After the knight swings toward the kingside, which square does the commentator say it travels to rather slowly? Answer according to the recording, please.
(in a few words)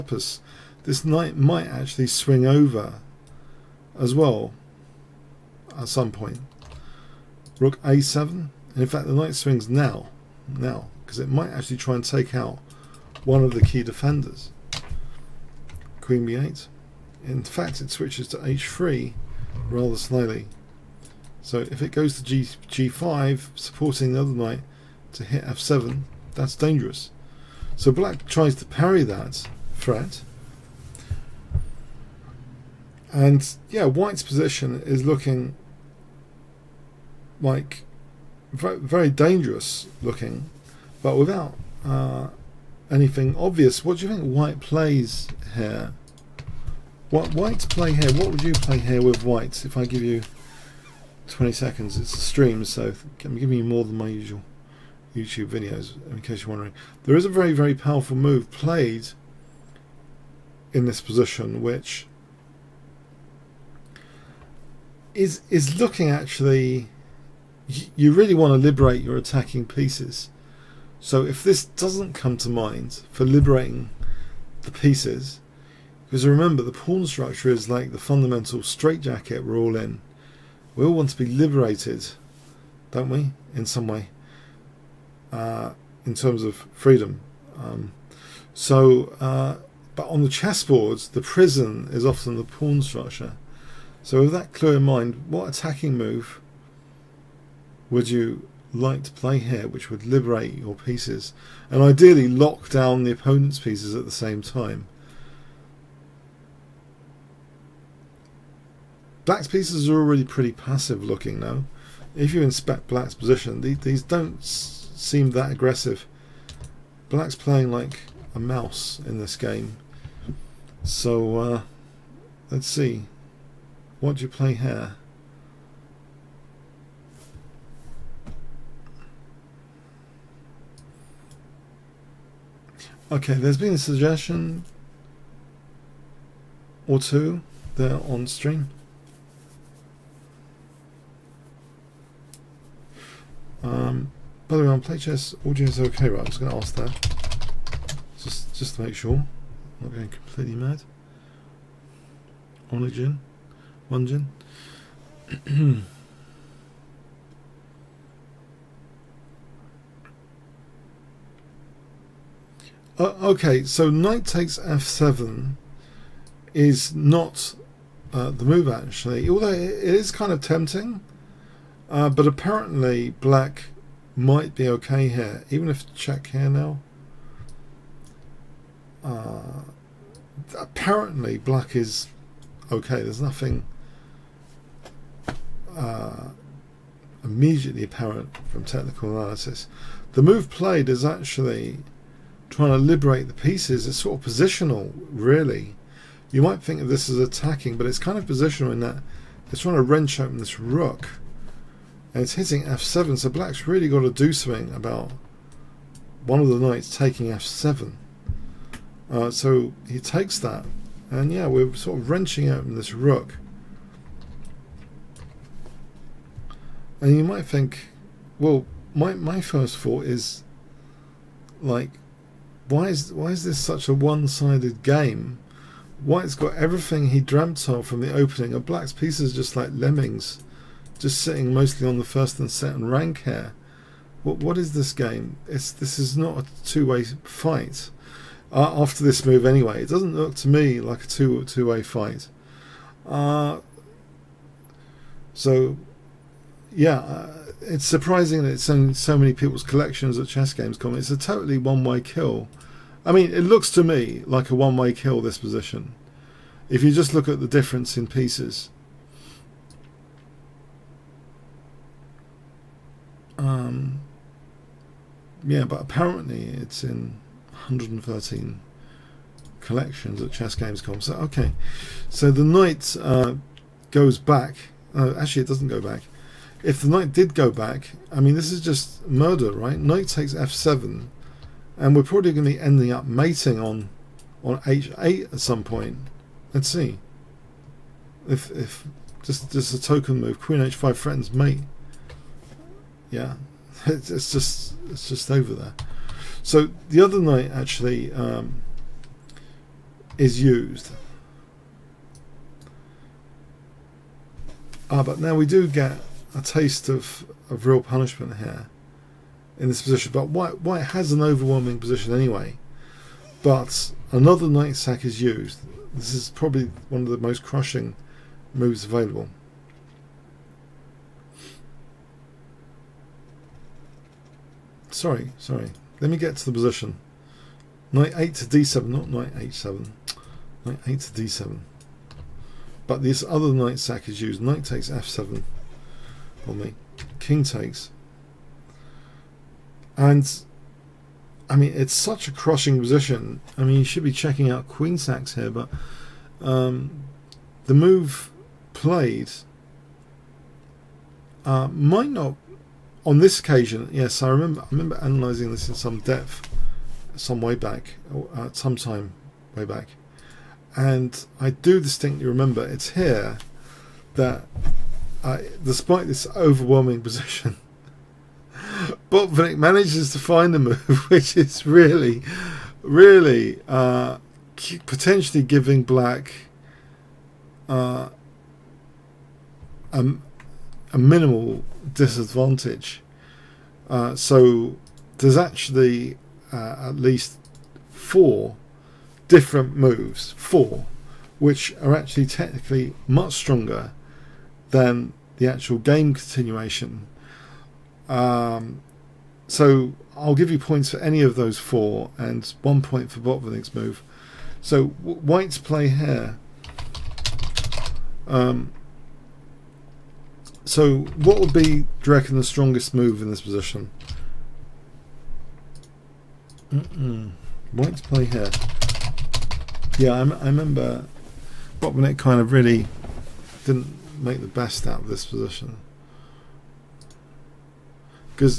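h3.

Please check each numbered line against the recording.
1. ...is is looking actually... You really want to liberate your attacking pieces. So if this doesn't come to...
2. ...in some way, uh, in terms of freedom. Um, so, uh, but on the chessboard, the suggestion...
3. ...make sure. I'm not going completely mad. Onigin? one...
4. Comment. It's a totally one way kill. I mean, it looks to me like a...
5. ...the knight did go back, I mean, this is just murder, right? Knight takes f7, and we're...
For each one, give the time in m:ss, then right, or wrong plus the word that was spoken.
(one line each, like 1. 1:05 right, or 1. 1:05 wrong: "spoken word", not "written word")
1. 1:05 right
2. 1:23 wrong: "prison", not "suggestion"
3. 2:28 right
4. 4:10 right
5. 4:36 right.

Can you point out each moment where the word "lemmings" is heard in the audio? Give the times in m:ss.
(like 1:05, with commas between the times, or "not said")
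3:49.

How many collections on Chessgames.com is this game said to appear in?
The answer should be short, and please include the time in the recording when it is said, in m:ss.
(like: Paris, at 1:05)
113, at 4:27.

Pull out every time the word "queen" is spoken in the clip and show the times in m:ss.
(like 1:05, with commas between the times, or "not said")
0:16, 4:50, 5:44.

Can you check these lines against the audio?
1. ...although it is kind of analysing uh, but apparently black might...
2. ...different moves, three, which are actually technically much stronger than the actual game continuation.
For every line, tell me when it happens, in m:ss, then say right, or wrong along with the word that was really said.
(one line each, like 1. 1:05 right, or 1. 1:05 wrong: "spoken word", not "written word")
1. 2:49 wrong: "tempting", not "analysing"
2. 6:29 wrong: "four", not "three".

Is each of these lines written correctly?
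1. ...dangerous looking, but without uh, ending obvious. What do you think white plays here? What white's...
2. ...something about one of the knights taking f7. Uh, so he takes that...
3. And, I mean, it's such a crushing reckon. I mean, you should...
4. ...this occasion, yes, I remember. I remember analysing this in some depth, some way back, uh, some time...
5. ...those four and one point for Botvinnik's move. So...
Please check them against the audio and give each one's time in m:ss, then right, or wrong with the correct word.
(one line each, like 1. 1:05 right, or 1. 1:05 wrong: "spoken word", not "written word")
1. 0:39 wrong: "anything", not "ending"
2. 3:24 right
3. 5:39 wrong: "position", not "reckon"
4. 5:53 right
5. 6:41 right.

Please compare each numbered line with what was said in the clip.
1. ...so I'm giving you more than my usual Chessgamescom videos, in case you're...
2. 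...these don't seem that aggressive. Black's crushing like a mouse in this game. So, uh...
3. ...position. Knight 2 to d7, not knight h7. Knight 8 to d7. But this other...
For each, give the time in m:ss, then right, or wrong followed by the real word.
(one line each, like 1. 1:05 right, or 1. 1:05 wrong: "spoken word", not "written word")
1. 0:52 wrong: "YouTube", not "Chessgamescom"
2. 1:53 wrong: "playing", not "crushing"
3. 5:26 wrong: "8", not "2".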